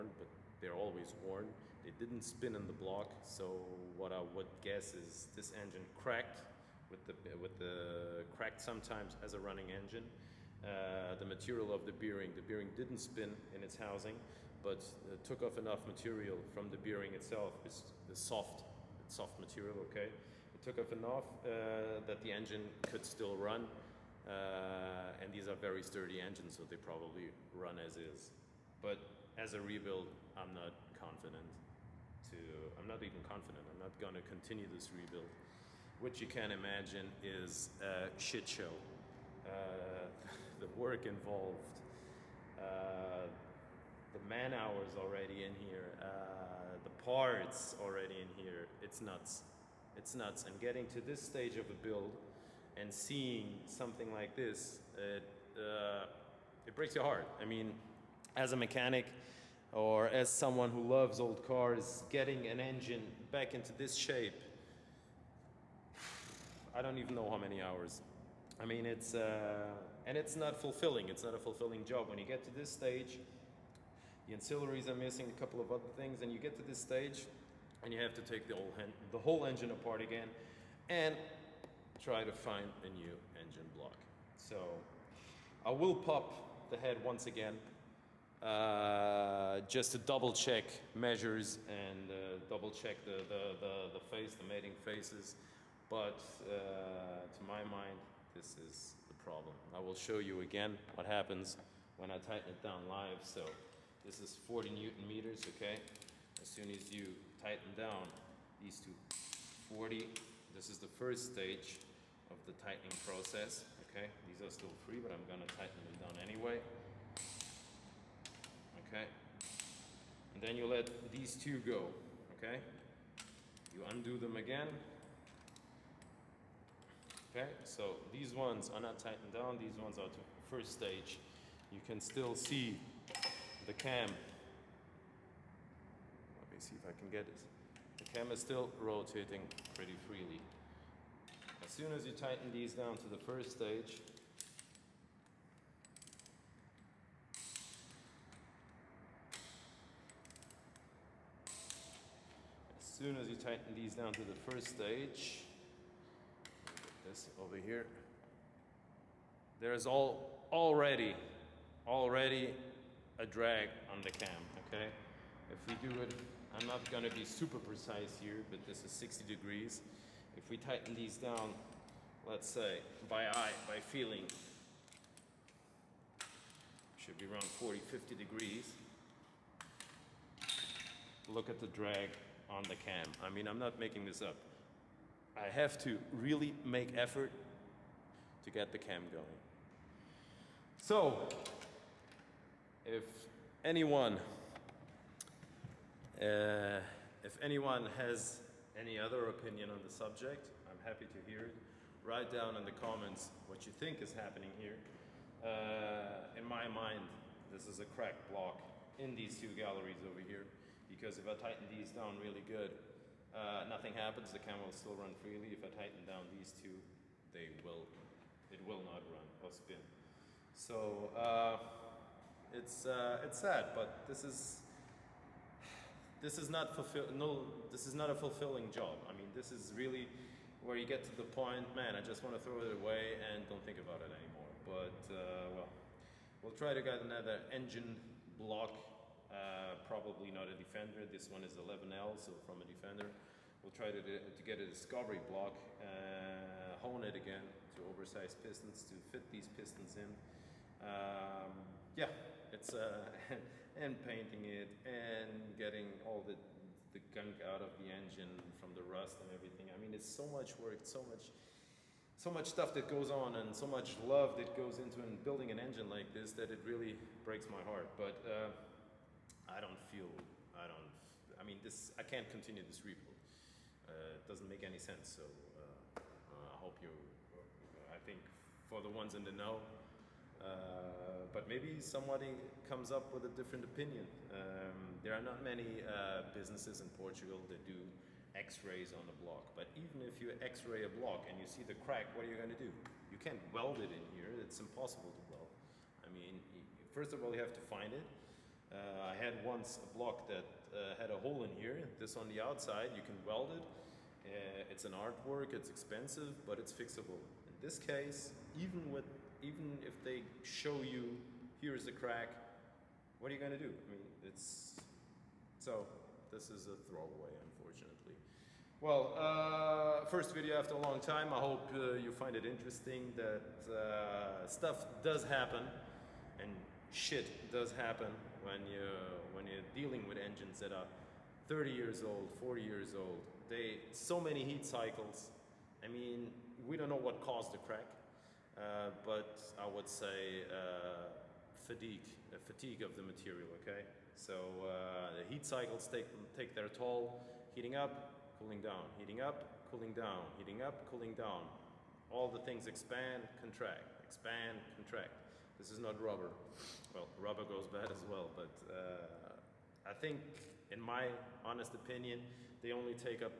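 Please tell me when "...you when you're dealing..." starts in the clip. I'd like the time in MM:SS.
05:28.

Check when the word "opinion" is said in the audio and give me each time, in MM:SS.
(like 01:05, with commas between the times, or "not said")
03:19, 04:43, 06:01.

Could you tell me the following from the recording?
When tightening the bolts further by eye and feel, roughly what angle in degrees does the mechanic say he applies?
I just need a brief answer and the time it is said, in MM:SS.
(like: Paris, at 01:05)
60 degrees, at 02:48.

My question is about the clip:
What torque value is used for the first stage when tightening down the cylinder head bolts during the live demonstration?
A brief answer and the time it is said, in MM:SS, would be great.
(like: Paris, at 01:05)
40 Newton meters, at 01:44.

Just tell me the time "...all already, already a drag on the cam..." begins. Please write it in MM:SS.
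02:39.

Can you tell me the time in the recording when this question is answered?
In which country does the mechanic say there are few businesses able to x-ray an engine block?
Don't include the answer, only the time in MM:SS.
04:46.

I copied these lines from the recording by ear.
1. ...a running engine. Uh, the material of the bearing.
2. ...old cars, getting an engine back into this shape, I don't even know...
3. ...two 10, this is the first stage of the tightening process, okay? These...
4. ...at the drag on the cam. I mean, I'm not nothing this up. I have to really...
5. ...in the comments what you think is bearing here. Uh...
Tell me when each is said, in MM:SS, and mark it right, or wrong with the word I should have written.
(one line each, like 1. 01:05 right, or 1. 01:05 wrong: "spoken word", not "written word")
1. 00:09 right
2. 01:01 right
3. 01:48 wrong: "40", not "10"
4. 03:01 wrong: "making", not "nothing"
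5. 03:22 wrong: "happening", not "bearing".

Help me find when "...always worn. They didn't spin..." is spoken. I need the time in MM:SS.
00:00.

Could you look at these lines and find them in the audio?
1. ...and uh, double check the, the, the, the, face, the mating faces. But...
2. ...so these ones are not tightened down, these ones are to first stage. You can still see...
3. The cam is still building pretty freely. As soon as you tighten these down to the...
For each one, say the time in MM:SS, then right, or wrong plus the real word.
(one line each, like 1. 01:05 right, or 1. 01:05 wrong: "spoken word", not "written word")
1. 01:31 right
2. 02:07 right
3. 02:17 wrong: "rotating", not "building".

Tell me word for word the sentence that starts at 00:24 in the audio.
Uh, and these are very sturdy engines, so they probably run as is.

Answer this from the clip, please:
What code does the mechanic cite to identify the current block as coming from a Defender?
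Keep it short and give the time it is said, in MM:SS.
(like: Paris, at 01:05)
11L, at 04:01.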